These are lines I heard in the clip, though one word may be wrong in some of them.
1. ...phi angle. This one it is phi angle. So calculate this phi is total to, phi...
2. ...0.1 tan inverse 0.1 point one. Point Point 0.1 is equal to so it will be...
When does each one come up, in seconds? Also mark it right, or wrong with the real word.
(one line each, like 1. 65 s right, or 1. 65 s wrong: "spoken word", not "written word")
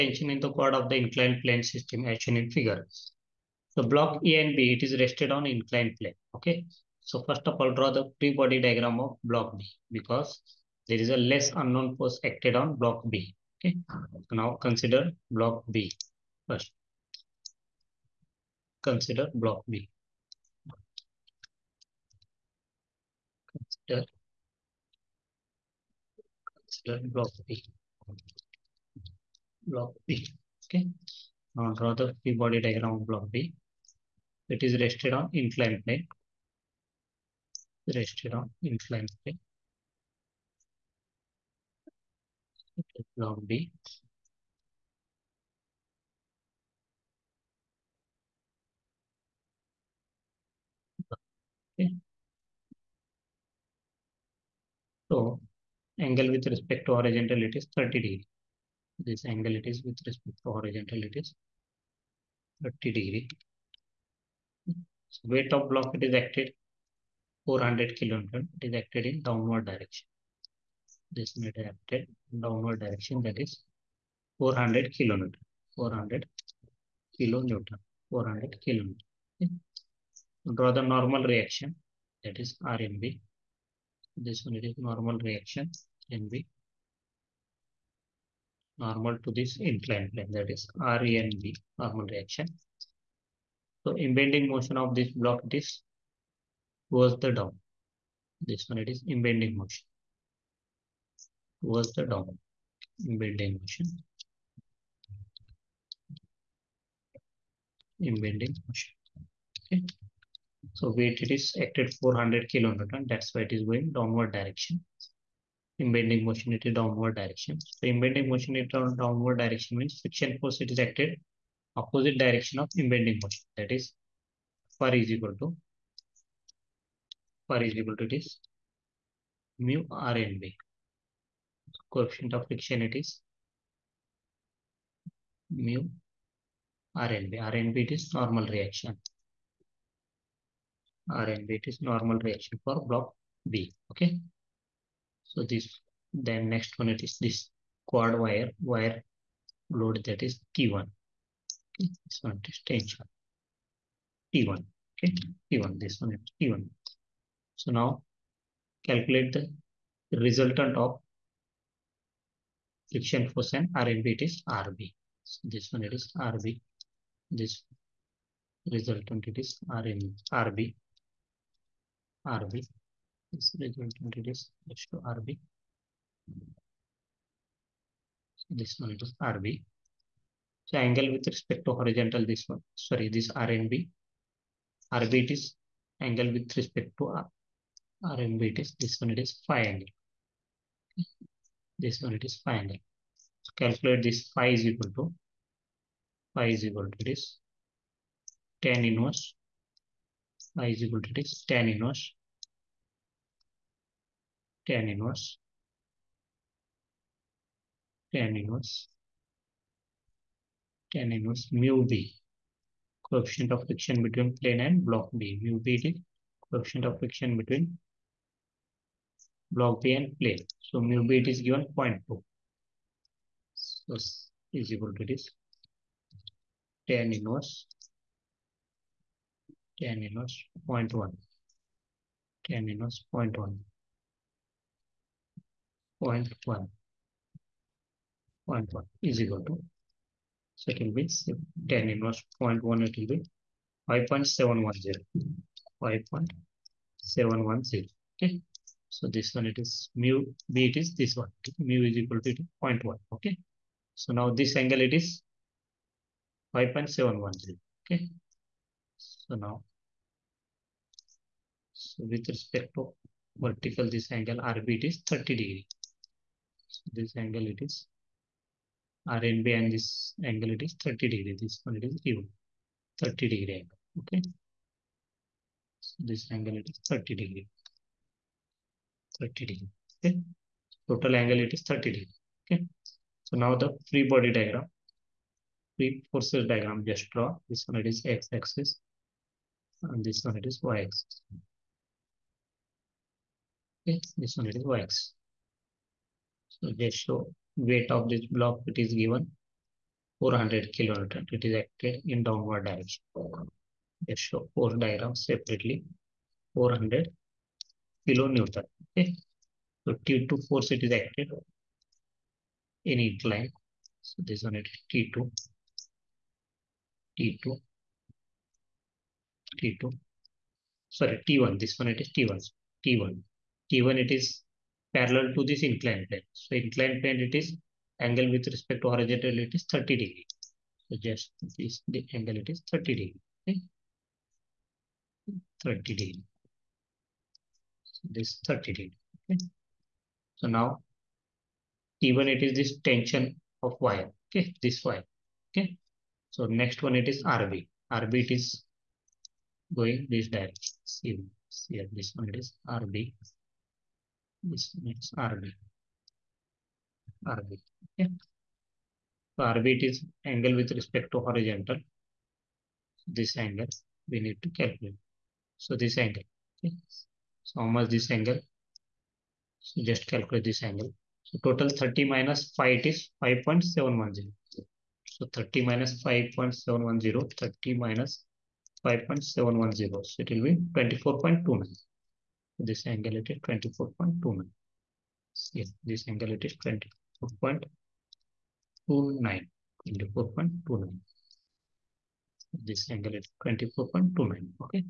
1. 189 s wrong: "equal", not "total"
2. 230 s right.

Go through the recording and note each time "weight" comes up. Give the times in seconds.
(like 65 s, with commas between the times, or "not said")
65 s, 110 s, 297 s.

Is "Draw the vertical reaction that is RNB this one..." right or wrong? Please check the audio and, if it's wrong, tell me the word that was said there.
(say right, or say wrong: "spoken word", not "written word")
wrong: "normal", not "vertical".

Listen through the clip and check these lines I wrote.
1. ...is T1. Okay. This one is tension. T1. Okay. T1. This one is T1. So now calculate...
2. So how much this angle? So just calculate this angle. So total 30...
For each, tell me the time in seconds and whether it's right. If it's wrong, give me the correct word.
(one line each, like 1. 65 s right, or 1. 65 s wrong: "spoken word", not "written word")
1. 150 s right
2. 367 s right.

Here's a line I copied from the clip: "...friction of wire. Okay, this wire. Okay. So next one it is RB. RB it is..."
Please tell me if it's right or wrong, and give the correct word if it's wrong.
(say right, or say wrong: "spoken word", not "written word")
wrong: "tension", not "friction".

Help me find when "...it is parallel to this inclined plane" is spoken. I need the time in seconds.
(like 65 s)
323 s.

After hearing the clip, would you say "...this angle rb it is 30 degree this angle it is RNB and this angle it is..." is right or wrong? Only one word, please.
right.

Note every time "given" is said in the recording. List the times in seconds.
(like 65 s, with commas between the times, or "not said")
221 s, 298 s.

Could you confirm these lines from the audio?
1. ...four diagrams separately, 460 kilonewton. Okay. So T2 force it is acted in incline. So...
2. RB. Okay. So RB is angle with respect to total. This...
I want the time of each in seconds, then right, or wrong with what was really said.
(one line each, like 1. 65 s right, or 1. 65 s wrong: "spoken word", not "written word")
1. 304 s wrong: "400", not "460"
2. 357 s wrong: "horizontal", not "total".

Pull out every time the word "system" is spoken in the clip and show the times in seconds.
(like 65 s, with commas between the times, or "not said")
1 s.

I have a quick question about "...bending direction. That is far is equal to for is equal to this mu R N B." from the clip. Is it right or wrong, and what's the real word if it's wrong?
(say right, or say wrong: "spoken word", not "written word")
wrong: "motion", not "direction".